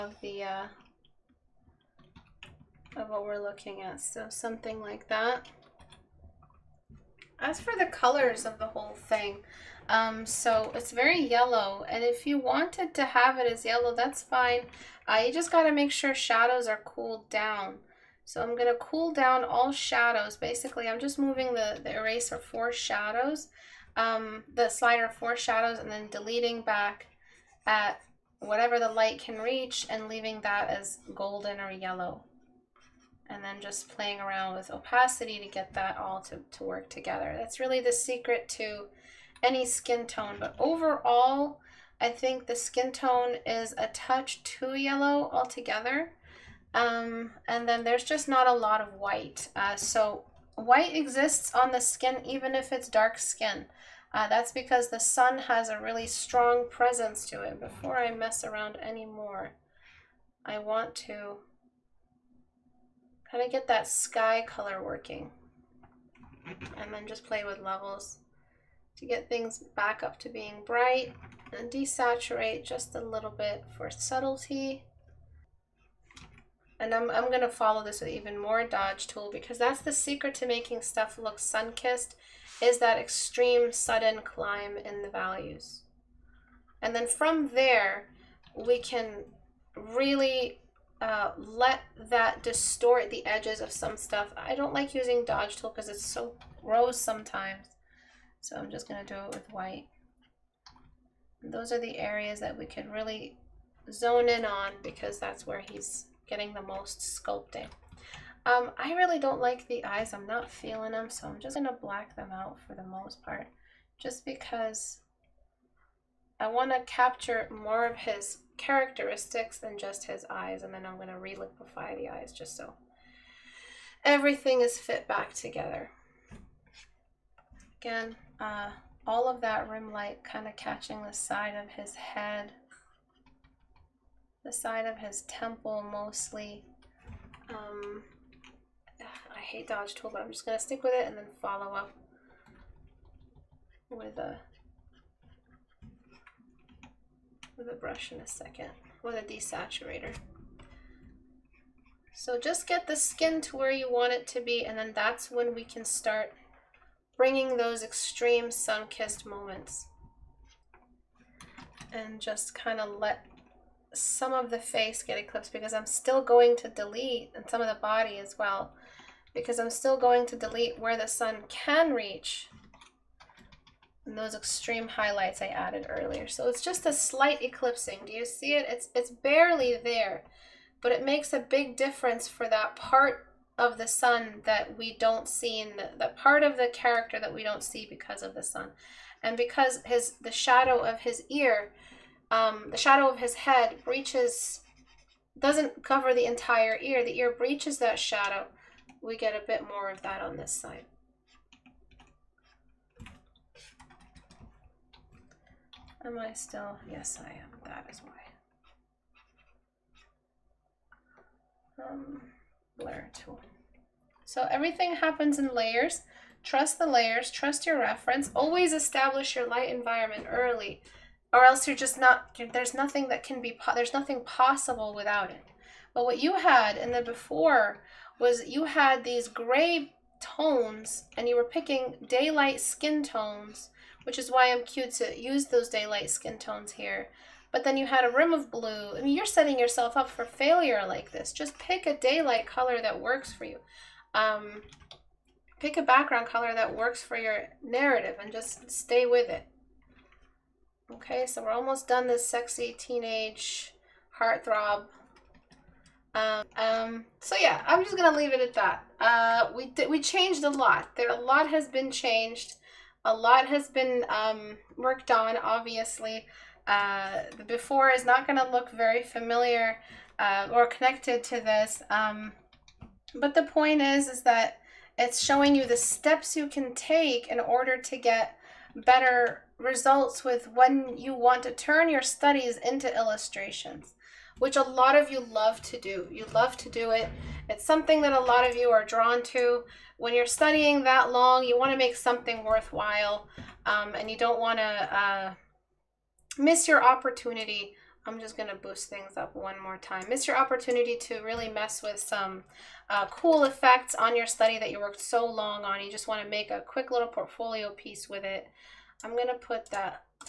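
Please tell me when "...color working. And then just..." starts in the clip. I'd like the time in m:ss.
1:04.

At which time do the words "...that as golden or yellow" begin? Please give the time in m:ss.
0:30.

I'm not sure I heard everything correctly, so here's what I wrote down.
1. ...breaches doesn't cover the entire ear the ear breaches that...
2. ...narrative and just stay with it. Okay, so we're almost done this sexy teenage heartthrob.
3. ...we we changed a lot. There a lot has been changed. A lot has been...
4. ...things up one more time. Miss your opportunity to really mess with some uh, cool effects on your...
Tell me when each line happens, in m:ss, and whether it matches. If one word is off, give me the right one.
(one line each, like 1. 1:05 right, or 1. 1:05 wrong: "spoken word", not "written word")
1. 3:13 right
2. 4:07 right
3. 4:19 right
4. 4:58 right.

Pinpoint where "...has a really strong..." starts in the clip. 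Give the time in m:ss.
0:55.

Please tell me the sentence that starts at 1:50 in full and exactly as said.
I'm not feeling them, so I'm just going to black them out for the most part.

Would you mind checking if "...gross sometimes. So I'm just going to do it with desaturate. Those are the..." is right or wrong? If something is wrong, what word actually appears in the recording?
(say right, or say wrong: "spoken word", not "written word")
wrong: "white", not "desaturate".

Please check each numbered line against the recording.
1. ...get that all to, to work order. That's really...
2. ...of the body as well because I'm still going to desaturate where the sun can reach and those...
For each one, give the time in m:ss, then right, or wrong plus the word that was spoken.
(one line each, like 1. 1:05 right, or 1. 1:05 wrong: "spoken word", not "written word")
1. 0:35 wrong: "together", not "order"
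2. 2:47 wrong: "delete", not "desaturate".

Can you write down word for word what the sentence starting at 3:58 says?
I mean, you're setting yourself up for failure like this.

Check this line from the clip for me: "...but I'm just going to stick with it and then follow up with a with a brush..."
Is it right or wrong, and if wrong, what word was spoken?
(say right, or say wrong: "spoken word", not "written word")
right.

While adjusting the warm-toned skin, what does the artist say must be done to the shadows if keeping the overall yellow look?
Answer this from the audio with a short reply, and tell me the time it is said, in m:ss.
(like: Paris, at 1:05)
Cooled down, at 0:16.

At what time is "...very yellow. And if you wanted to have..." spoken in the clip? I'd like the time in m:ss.
0:10.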